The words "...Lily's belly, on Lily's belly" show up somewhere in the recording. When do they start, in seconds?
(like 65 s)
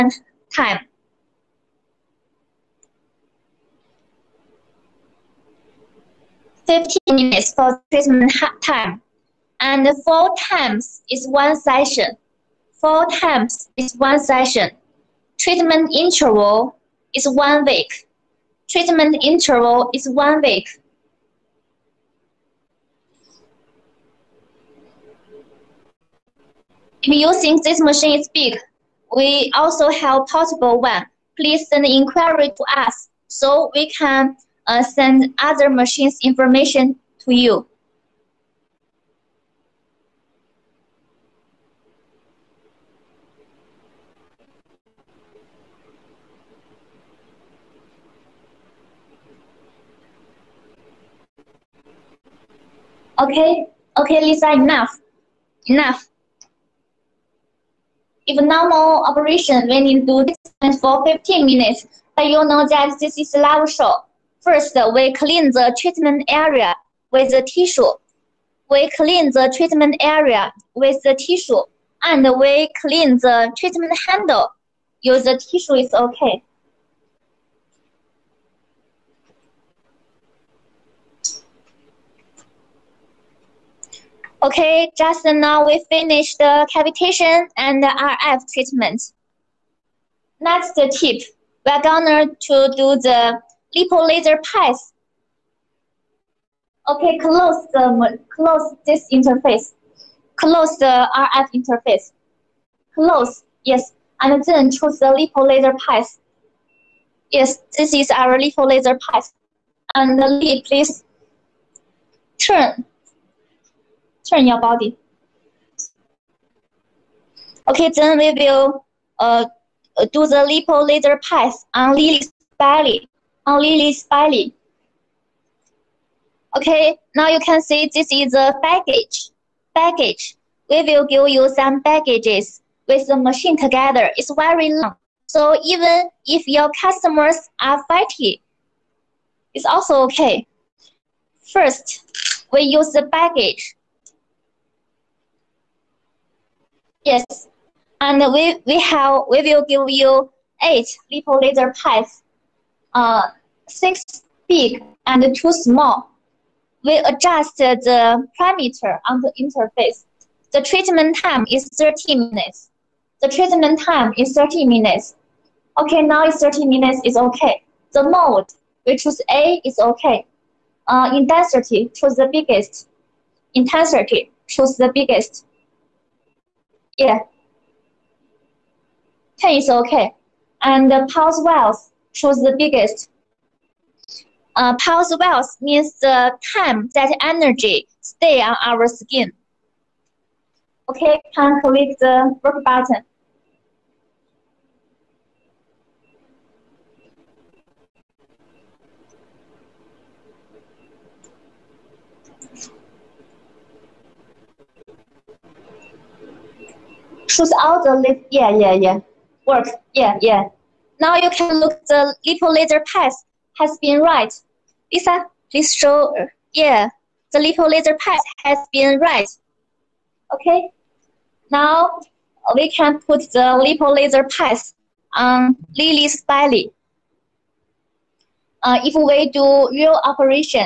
121 s.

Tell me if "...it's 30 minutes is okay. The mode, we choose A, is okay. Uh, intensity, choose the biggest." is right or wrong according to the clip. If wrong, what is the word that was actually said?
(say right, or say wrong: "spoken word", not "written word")
right.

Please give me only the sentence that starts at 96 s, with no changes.
Okay, close the close this interface.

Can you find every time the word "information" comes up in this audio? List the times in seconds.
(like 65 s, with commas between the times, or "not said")
36 s.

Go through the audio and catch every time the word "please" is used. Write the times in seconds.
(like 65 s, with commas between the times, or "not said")
31 s, 110 s, 215 s.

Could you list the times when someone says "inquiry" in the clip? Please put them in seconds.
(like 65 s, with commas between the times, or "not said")
31 s.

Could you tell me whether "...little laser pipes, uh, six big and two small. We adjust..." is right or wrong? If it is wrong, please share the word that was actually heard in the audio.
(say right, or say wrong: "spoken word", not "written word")
right.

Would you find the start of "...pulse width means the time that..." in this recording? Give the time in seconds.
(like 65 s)
184 s.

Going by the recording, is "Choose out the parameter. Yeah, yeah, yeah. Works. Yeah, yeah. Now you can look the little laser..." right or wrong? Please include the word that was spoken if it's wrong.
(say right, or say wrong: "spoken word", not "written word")
wrong: "laser", not "parameter".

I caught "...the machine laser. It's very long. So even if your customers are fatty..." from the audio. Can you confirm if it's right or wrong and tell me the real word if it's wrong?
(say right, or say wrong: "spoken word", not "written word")
wrong: "together", not "laser".